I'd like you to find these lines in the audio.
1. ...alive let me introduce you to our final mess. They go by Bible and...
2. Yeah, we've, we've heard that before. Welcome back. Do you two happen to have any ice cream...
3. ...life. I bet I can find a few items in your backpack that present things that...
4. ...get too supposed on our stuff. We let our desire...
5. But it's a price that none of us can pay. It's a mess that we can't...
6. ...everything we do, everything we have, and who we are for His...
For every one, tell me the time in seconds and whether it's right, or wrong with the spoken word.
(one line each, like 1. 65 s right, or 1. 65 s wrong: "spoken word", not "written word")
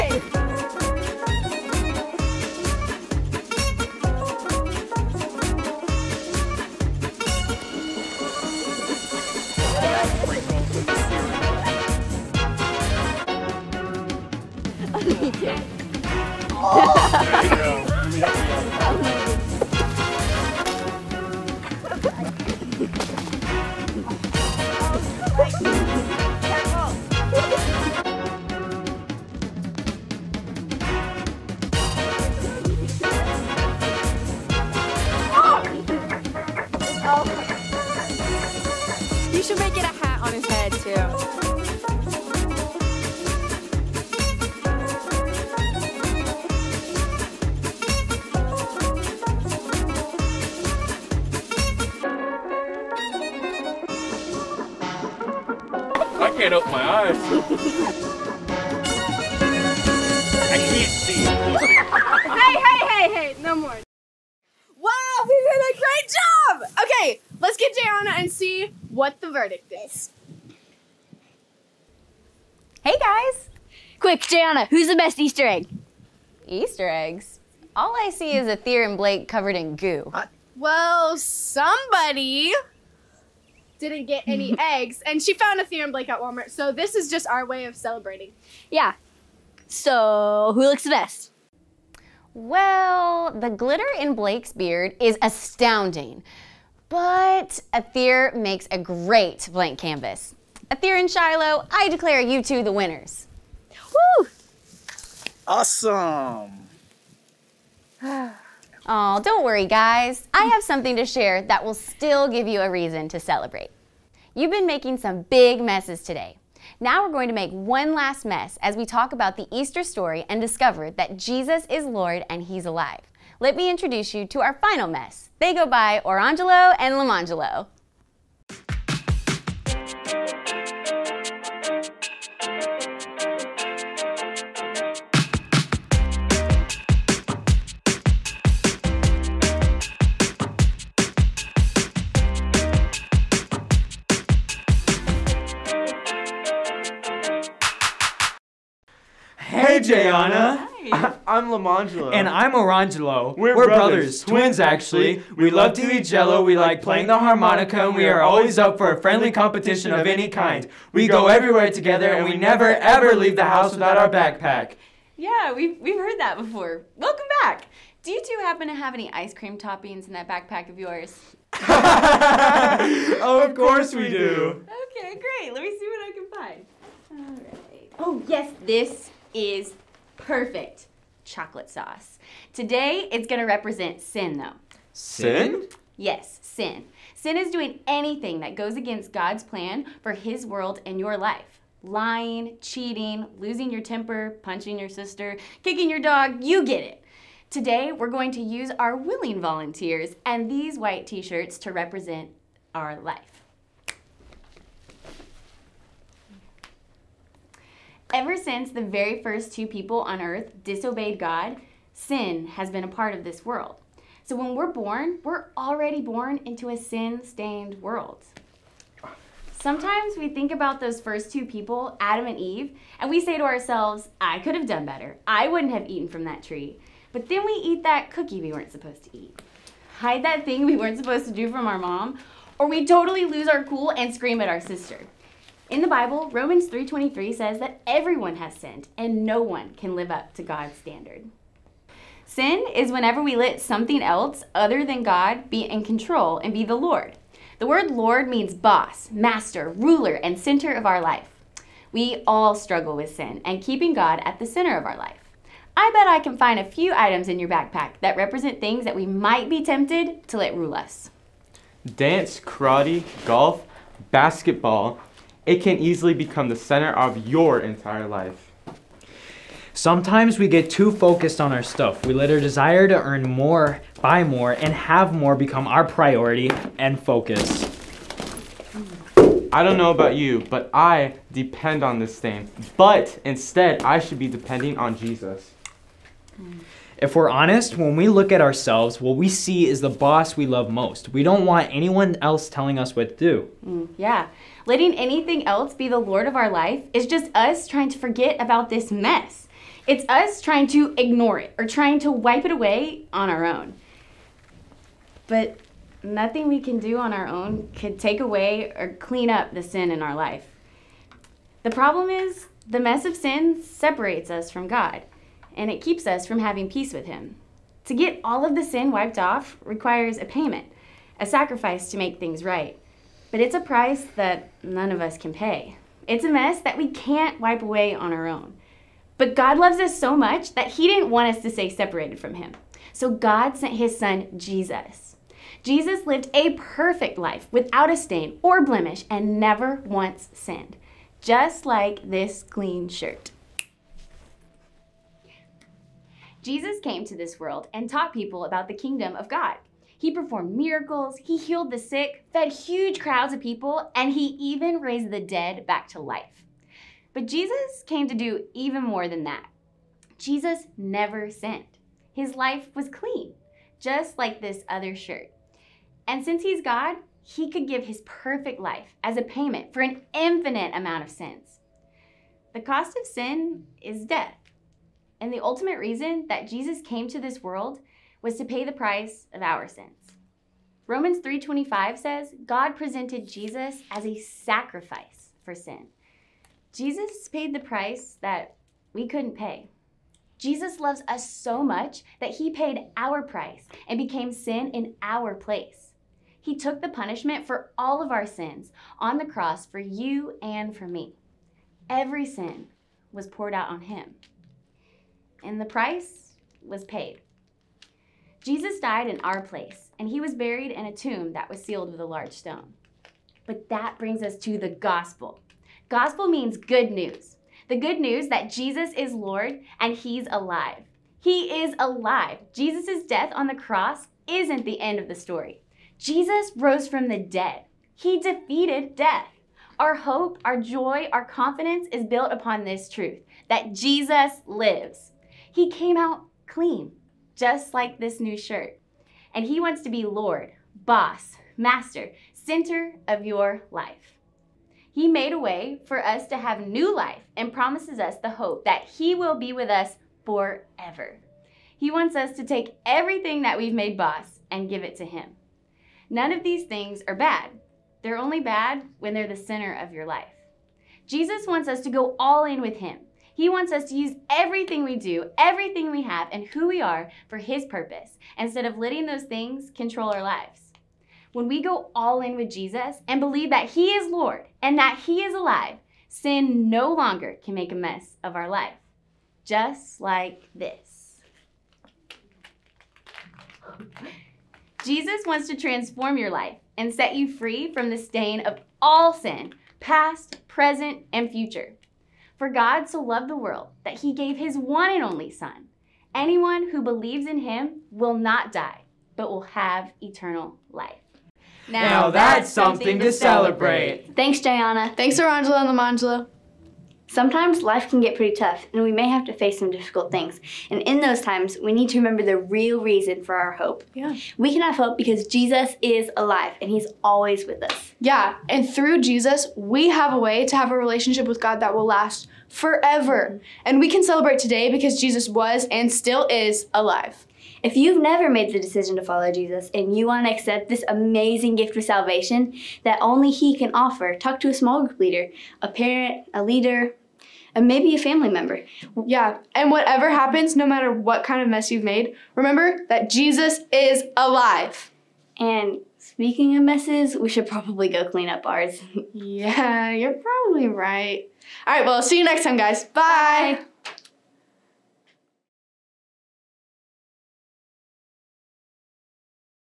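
1. 122 s wrong: "Orangelo", not "Bible"
2. 165 s right
3. 254 s wrong: "represent", not "present"
4. 270 s wrong: "focused", not "supposed"
5. 323 s right
6. 464 s right.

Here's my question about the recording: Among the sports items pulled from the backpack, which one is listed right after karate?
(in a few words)
Golf.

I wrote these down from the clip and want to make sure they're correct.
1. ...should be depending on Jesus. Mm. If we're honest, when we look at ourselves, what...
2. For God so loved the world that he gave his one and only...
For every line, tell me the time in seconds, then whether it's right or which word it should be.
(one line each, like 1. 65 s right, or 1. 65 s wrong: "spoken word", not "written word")
1. 283 s right
2. 492 s right.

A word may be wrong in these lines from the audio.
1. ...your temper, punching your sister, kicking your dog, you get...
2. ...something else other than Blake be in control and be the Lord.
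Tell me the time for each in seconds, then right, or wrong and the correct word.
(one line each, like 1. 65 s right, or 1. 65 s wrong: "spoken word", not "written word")
1. 193 s right
2. 243 s wrong: "God", not "Blake".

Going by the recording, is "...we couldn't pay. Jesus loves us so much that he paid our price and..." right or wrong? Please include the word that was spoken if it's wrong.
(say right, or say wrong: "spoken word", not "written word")
right.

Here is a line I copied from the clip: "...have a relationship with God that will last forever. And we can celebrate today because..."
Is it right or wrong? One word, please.
right.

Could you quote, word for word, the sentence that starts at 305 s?
But nothing we can do on our own could take away or clean up the sin in our life.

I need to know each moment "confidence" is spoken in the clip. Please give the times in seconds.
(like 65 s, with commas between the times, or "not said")
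431 s.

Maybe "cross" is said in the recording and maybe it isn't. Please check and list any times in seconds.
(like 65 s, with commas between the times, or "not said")
399 s, 423 s.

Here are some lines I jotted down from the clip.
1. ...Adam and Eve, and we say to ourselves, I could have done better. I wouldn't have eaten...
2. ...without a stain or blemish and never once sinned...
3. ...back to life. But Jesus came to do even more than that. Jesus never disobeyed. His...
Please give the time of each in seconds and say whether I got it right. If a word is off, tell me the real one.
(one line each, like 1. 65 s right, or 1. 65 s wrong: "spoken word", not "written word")
1. 221 s right
2. 337 s right
3. 355 s wrong: "sinned", not "disobeyed".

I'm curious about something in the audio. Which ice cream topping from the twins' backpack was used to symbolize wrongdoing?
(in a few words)
Chocolate sauce.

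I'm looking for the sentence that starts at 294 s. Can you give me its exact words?
Letting anything else be the lord of our life is just us trying to forget about this mess.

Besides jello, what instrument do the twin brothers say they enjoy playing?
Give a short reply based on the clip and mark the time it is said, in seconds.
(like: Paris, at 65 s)
Harmonica, at 157 s.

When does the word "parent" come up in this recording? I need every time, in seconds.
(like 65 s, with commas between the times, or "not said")
535 s.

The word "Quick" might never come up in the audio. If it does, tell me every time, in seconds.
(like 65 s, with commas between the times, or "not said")
73 s.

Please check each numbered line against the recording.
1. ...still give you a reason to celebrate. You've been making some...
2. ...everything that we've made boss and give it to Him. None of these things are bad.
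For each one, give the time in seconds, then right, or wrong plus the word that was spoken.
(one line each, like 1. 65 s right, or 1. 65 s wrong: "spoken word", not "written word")
1. 111 s right
2. 452 s right.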